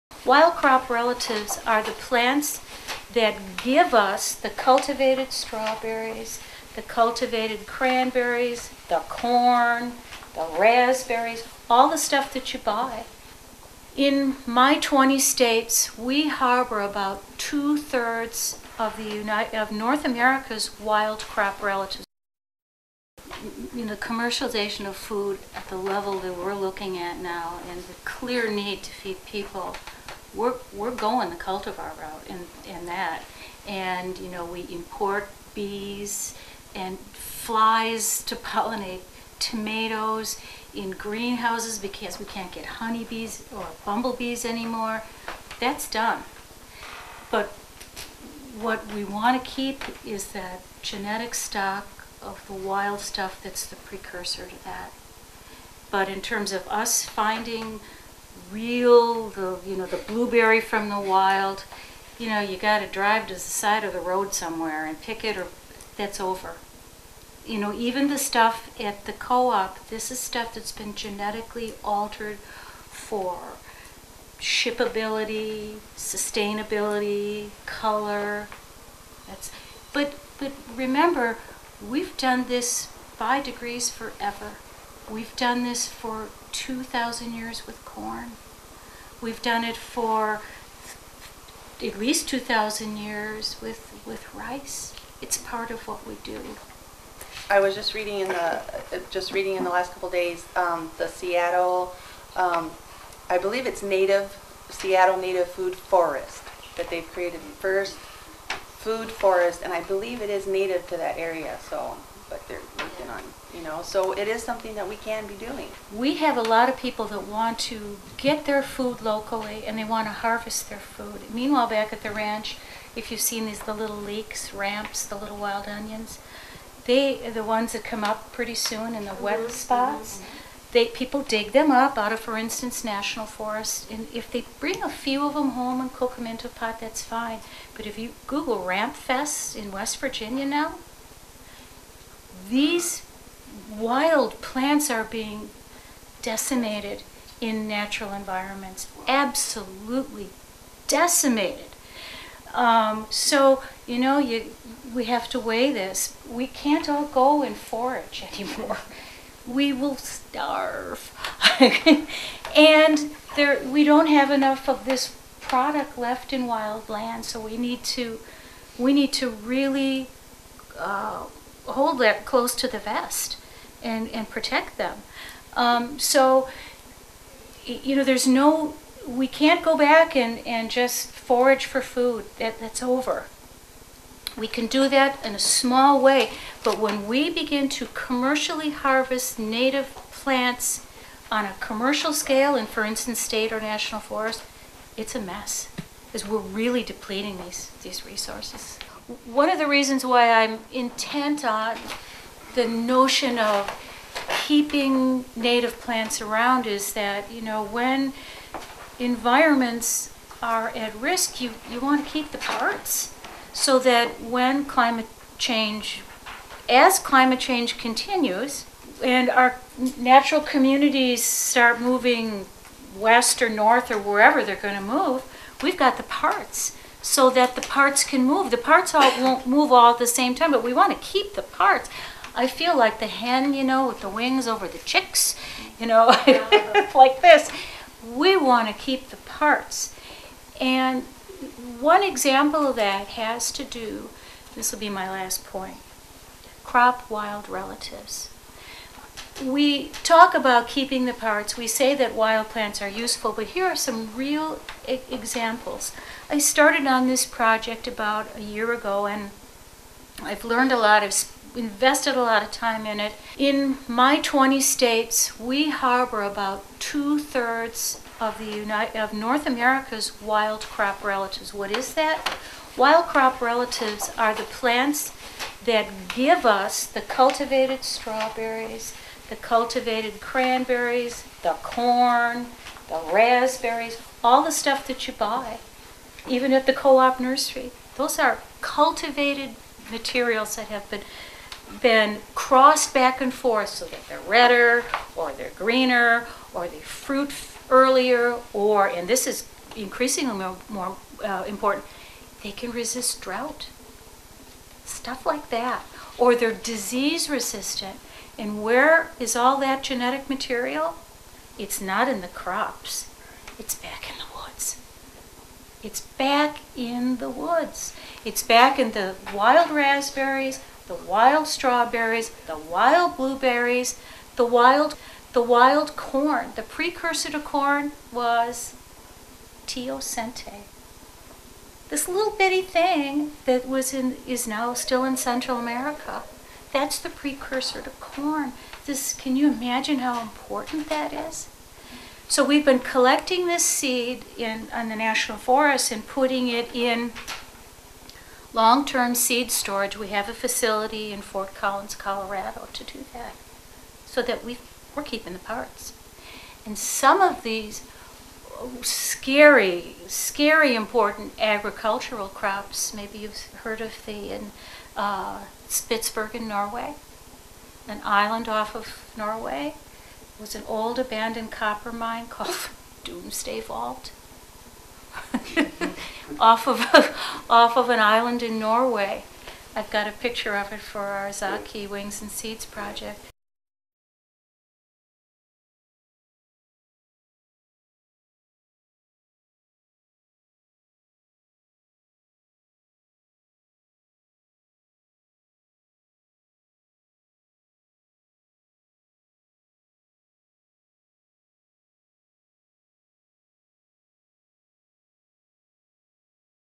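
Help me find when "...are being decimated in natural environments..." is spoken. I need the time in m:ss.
2:24.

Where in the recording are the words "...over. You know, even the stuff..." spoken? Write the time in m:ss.
1:06.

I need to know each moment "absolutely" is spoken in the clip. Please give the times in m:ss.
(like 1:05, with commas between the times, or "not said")
2:29.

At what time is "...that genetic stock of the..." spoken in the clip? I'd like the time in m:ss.
0:50.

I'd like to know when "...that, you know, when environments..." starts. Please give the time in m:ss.
3:26.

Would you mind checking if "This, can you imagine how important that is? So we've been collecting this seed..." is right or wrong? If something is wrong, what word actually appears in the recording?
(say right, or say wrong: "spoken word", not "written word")
right.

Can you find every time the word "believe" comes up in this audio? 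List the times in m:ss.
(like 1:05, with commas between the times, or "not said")
1:43, 1:49.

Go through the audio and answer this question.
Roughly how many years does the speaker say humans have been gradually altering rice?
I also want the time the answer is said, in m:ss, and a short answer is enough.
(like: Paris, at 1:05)
at least 2,000 years, at 1:31.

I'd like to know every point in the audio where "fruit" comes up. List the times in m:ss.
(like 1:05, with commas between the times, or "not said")
4:56.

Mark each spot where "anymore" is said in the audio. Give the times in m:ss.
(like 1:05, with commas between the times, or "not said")
0:44, 2:38.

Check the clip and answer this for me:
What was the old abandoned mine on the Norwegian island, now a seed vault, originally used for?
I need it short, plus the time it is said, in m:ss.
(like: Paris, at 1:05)
copper, at 6:11.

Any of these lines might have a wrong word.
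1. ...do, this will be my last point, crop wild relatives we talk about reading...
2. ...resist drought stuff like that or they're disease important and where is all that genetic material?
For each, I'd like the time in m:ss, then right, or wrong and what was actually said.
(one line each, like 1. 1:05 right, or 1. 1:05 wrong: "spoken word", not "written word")
1. 4:03 wrong: "keeping", not "reading"
2. 5:02 wrong: "resistant", not "important".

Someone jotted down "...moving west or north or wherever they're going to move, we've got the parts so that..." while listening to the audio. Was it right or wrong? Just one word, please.
right.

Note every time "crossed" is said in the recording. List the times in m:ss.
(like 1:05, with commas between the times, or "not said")
4:52.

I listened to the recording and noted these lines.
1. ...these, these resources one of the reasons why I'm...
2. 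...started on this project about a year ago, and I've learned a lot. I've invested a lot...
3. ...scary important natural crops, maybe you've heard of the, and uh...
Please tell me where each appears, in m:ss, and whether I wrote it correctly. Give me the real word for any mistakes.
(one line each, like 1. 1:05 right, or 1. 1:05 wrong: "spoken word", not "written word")
1. 3:17 right
2. 4:16 right
3. 6:00 wrong: "agricultural", not "natural".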